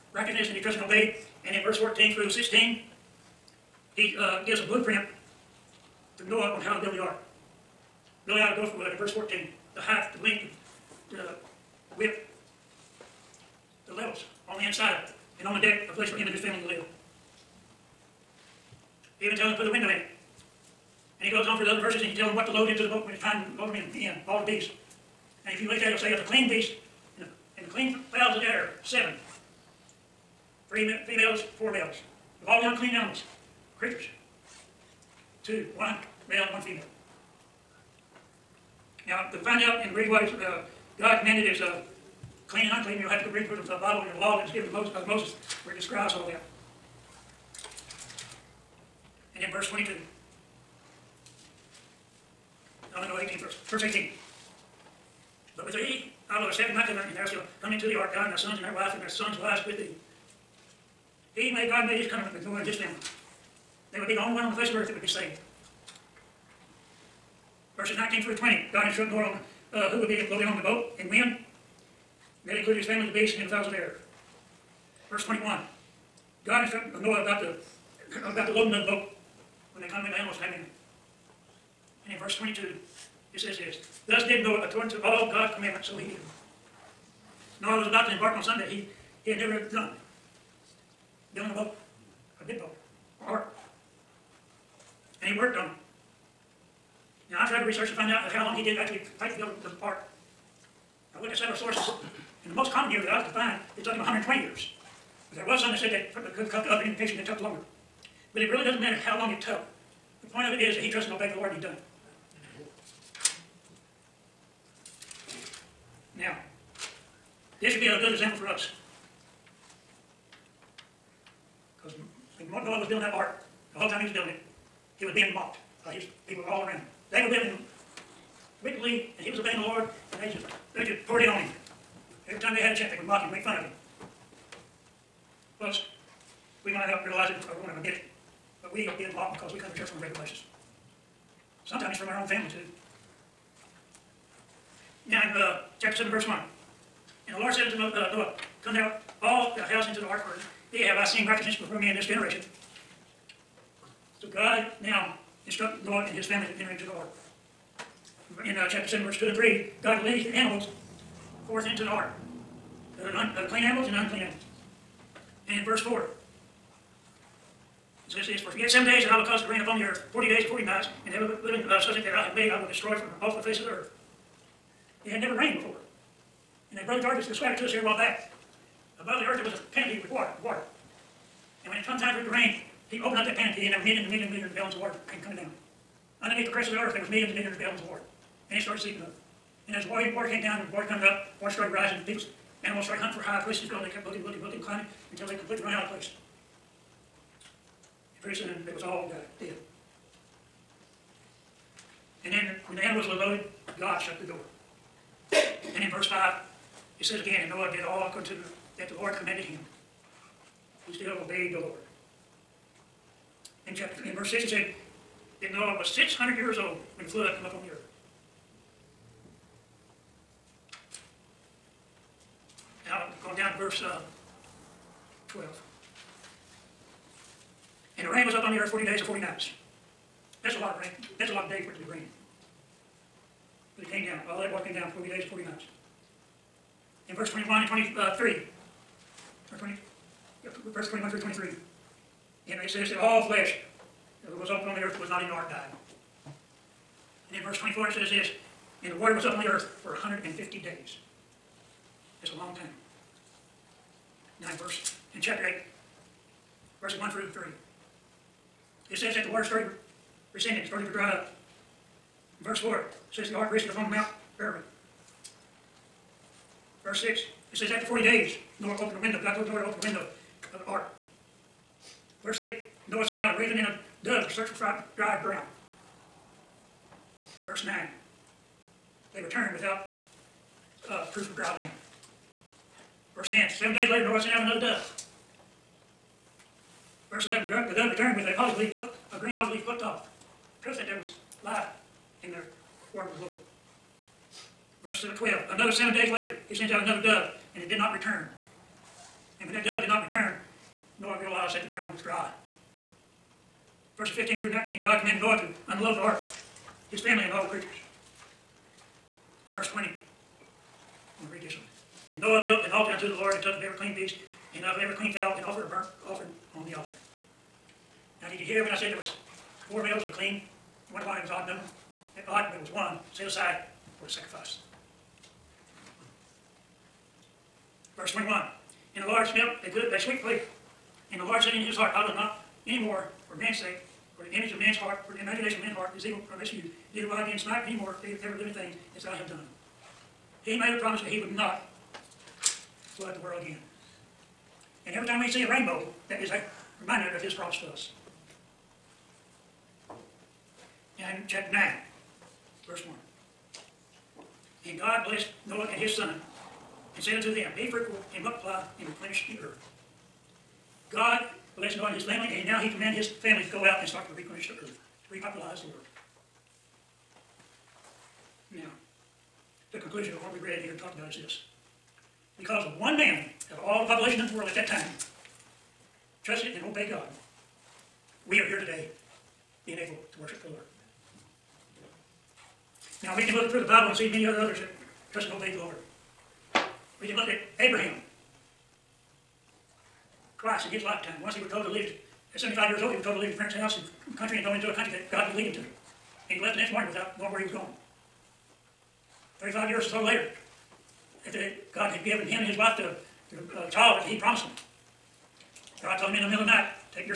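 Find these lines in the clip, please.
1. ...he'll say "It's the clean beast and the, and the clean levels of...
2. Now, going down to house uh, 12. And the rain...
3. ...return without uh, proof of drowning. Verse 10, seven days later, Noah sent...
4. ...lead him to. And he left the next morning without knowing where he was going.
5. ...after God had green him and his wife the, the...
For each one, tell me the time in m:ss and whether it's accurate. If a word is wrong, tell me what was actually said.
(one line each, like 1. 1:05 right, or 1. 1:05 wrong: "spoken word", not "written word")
1. 0:25 wrong: "fowls", not "levels"
2. 3:42 wrong: "verse", not "house"
3. 4:39 right
4. 6:35 right
5. 6:41 wrong: "given", not "green".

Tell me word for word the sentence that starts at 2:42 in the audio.
Of the, clean animals and the unclean animals.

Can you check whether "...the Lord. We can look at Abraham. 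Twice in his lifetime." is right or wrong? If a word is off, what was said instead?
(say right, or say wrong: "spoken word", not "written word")
right.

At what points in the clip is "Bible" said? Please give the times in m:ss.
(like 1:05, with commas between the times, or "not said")
0:43, 6:23.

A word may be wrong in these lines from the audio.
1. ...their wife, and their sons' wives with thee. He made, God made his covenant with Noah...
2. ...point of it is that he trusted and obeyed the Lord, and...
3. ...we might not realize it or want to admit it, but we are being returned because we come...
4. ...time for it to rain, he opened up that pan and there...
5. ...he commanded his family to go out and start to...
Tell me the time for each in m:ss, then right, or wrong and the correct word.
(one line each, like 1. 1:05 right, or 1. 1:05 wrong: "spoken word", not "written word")
1. 0:58 right
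2. 1:50 right
3. 2:16 wrong: "mocked", not "returned"
4. 3:01 right
5. 6:02 right.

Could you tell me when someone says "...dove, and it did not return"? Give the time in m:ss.
4:57.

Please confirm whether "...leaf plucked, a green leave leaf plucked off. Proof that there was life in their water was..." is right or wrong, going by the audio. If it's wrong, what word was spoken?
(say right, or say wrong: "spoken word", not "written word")
wrong: "olive", not "leave".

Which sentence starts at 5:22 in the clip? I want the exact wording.
It odd, but it was one set aside for the sacrifice.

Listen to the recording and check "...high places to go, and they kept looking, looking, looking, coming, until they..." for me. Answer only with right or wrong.
wrong.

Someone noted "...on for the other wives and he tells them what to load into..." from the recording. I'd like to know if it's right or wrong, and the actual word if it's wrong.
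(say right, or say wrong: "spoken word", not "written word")
wrong: "verses", not "wives".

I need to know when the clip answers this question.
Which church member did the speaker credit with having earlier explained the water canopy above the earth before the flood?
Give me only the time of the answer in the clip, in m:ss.
2:56.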